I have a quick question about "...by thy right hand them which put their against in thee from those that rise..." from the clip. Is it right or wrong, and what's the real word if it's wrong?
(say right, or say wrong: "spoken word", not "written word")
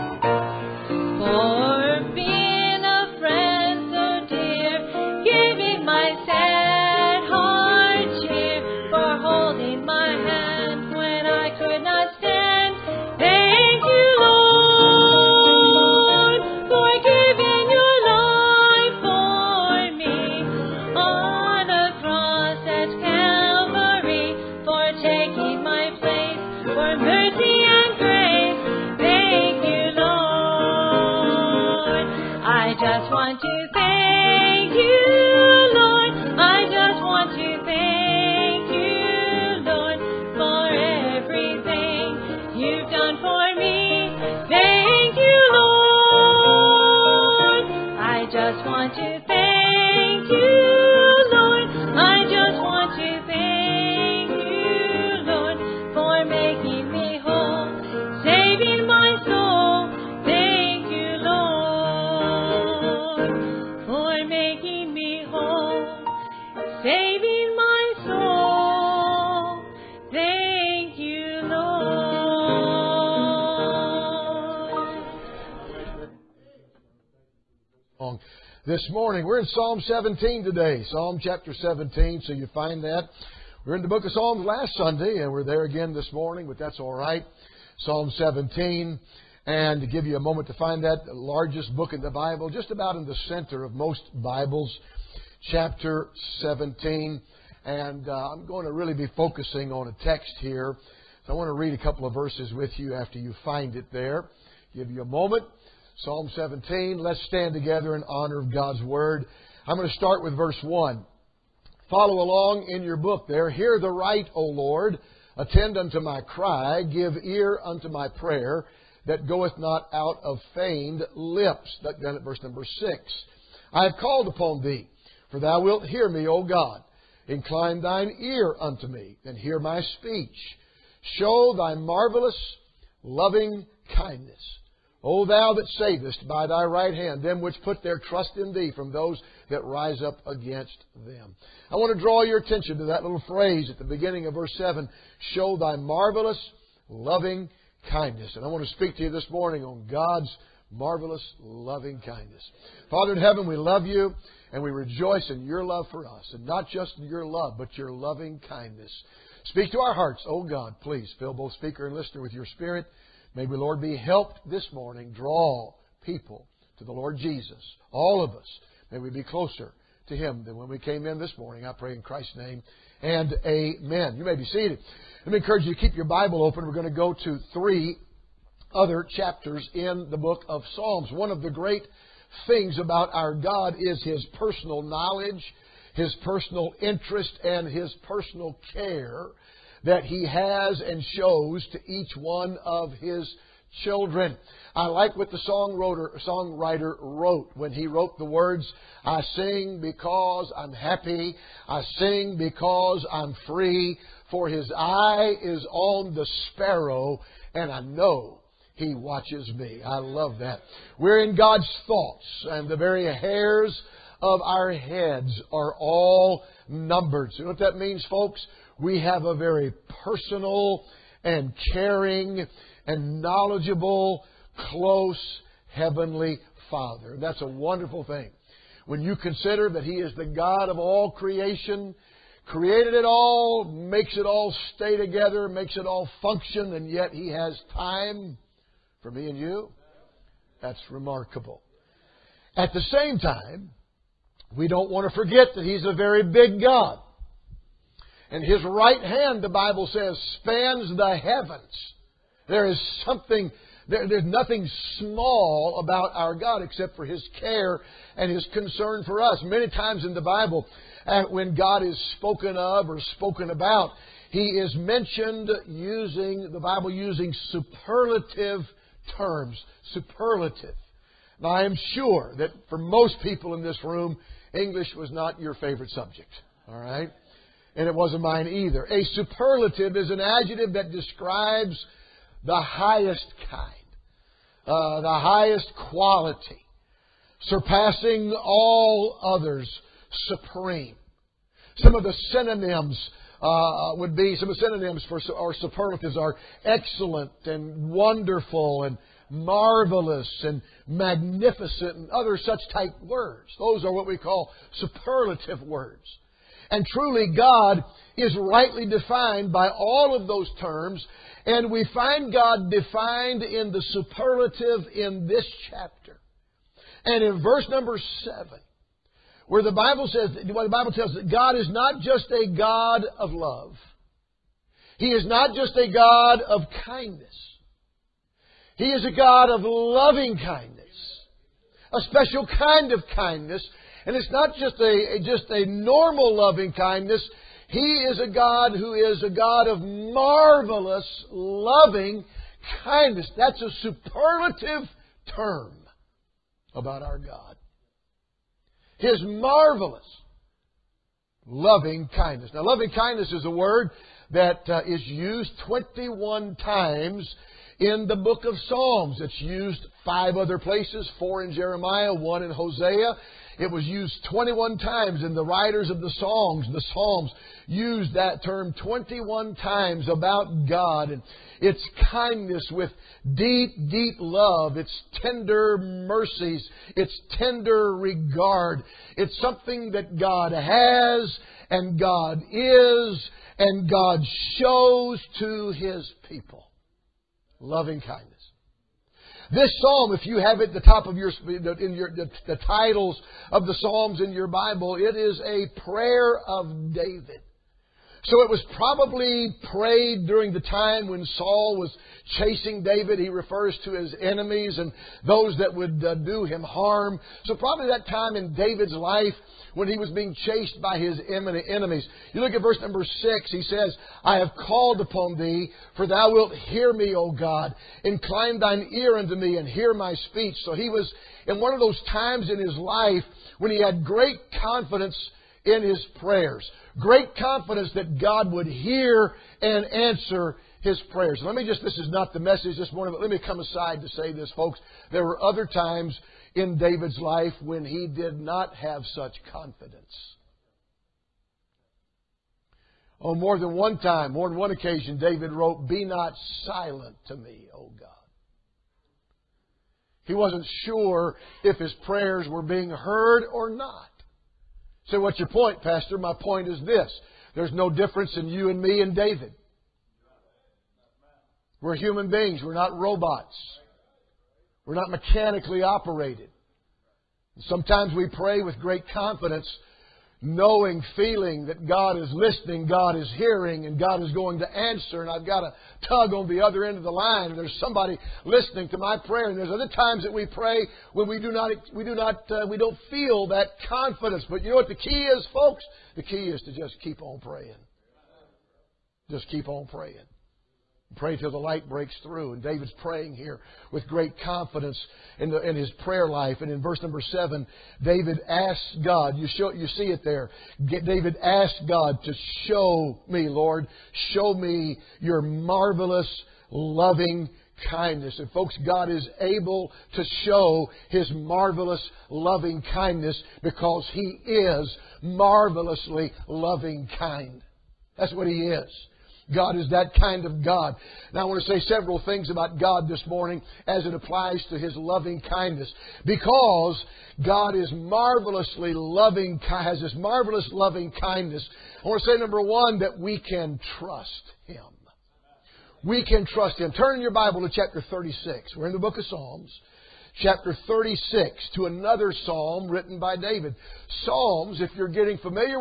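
wrong: "trust", not "against".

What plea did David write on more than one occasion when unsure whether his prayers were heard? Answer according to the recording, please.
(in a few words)
Be not silent to me.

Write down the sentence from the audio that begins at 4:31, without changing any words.
Now, I am sure that for most people in this room, English was not your favorite subject, all right?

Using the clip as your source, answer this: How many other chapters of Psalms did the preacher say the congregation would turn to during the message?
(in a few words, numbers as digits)
3.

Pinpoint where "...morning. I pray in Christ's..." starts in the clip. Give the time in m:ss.
2:51.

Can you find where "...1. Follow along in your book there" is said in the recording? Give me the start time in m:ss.
1:50.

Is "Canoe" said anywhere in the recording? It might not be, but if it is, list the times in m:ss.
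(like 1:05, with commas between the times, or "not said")
not said.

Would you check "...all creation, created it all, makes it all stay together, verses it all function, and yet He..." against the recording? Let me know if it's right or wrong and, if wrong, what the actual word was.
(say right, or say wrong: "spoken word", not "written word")
wrong: "makes", not "verses".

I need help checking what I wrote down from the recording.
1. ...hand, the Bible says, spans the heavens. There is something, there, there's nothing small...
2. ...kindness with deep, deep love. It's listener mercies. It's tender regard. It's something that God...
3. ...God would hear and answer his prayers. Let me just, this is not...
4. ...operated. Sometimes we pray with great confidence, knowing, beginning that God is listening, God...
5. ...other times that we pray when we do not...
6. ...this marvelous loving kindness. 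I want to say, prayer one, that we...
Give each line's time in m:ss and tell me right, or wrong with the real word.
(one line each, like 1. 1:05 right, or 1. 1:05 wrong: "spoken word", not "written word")
1. 4:09 right
2. 6:12 wrong: "tender", not "listener"
3. 7:08 right
4. 7:45 wrong: "feeling", not "beginning"
5. 7:59 right
6. 8:50 wrong: "number", not "prayer".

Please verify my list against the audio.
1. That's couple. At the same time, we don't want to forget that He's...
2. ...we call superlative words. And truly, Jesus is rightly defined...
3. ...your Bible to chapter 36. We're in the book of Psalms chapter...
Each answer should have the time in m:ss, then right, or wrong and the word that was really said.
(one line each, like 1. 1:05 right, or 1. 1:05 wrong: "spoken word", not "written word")
1. 4:00 wrong: "remarkable", not "couple"
2. 5:04 wrong: "God", not "Jesus"
3. 8:57 right.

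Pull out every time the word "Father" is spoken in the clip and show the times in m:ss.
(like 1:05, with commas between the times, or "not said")
2:32, 3:46.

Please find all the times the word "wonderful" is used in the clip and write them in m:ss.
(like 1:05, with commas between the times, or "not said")
3:47, 4:57.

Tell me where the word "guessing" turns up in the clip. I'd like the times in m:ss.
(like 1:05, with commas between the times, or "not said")
not said.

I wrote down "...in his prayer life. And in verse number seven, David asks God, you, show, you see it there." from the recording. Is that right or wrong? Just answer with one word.
right.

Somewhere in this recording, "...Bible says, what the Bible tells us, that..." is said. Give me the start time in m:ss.
5:19.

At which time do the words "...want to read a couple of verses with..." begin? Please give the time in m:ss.
1:41.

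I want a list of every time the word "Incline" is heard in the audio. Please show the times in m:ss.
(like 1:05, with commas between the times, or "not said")
2:07, 6:58.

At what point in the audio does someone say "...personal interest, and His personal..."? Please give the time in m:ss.
3:06.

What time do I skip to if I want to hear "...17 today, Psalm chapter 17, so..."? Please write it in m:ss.
1:19.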